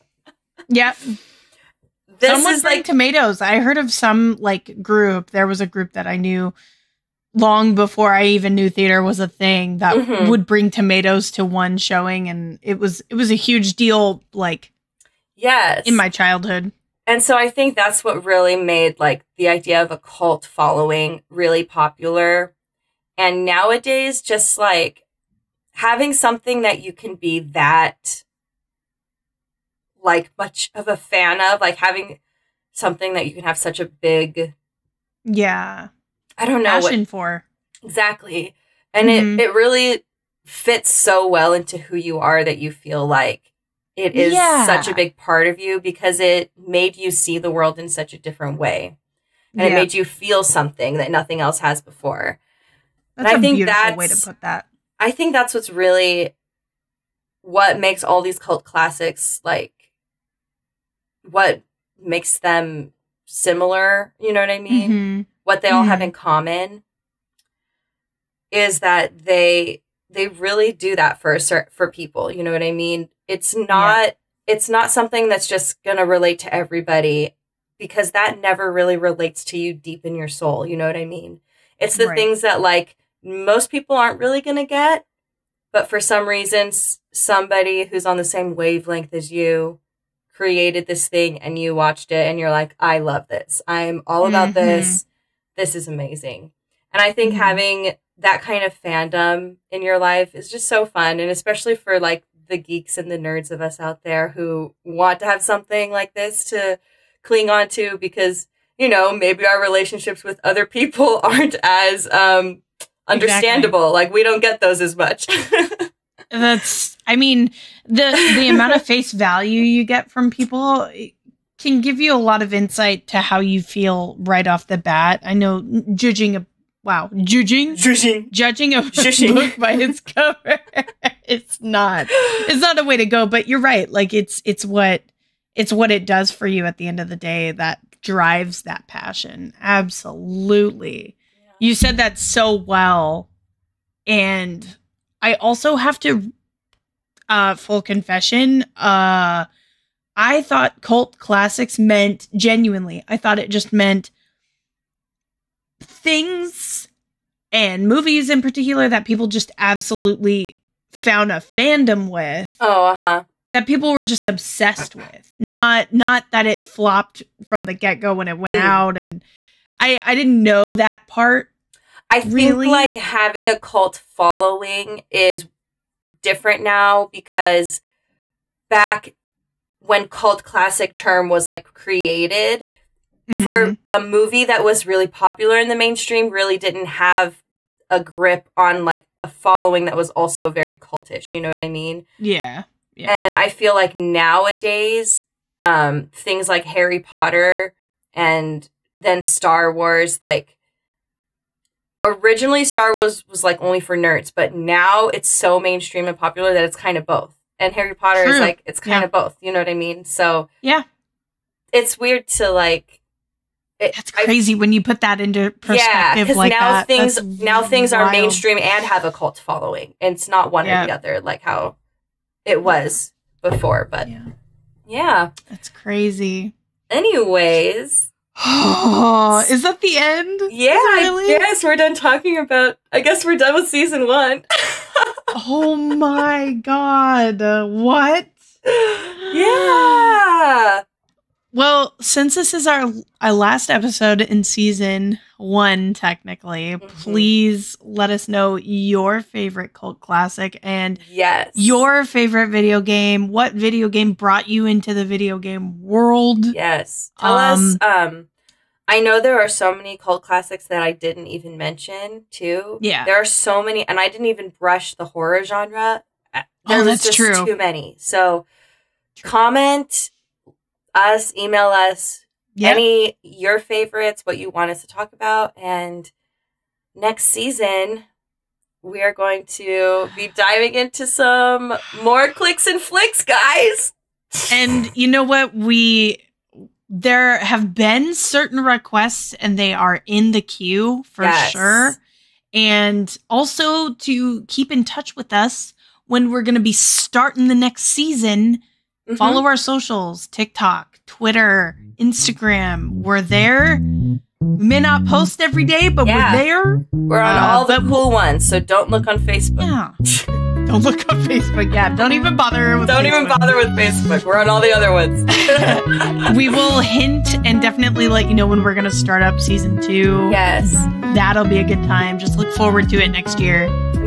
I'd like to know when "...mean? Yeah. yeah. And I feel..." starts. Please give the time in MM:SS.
03:11.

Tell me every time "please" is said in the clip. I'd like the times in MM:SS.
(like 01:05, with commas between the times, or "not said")
04:07.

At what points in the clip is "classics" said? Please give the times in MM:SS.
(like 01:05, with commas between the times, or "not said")
00:58, 02:31, 03:00, 04:09, 04:20.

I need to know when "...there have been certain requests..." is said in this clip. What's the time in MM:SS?
04:46.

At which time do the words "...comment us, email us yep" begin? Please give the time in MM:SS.
04:29.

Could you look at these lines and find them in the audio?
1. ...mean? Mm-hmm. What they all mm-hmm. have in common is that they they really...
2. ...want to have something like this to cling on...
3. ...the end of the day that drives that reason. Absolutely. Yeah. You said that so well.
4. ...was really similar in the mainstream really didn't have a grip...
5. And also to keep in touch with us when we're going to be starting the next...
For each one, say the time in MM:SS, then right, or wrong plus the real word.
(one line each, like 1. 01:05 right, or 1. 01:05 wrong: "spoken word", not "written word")
1. 01:04 right
2. 01:44 right
3. 02:16 wrong: "passion", not "reason"
4. 03:04 wrong: "popular", not "similar"
5. 04:52 right.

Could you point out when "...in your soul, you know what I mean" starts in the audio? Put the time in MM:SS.
01:20.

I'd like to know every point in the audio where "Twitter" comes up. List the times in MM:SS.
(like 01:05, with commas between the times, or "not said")
05:01.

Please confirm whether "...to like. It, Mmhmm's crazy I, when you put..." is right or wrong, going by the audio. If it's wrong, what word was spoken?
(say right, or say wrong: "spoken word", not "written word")
wrong: "That", not "Mmhmm".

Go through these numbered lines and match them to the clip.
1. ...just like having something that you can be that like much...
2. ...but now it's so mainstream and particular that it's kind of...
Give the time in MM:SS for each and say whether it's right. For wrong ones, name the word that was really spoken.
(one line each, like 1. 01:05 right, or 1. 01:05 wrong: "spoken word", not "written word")
1. 00:24 right
2. 03:24 wrong: "popular", not "particular".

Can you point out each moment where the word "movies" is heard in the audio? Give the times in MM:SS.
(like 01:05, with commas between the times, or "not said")
02:37, 03:03.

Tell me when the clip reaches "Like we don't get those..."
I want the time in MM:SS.
01:54.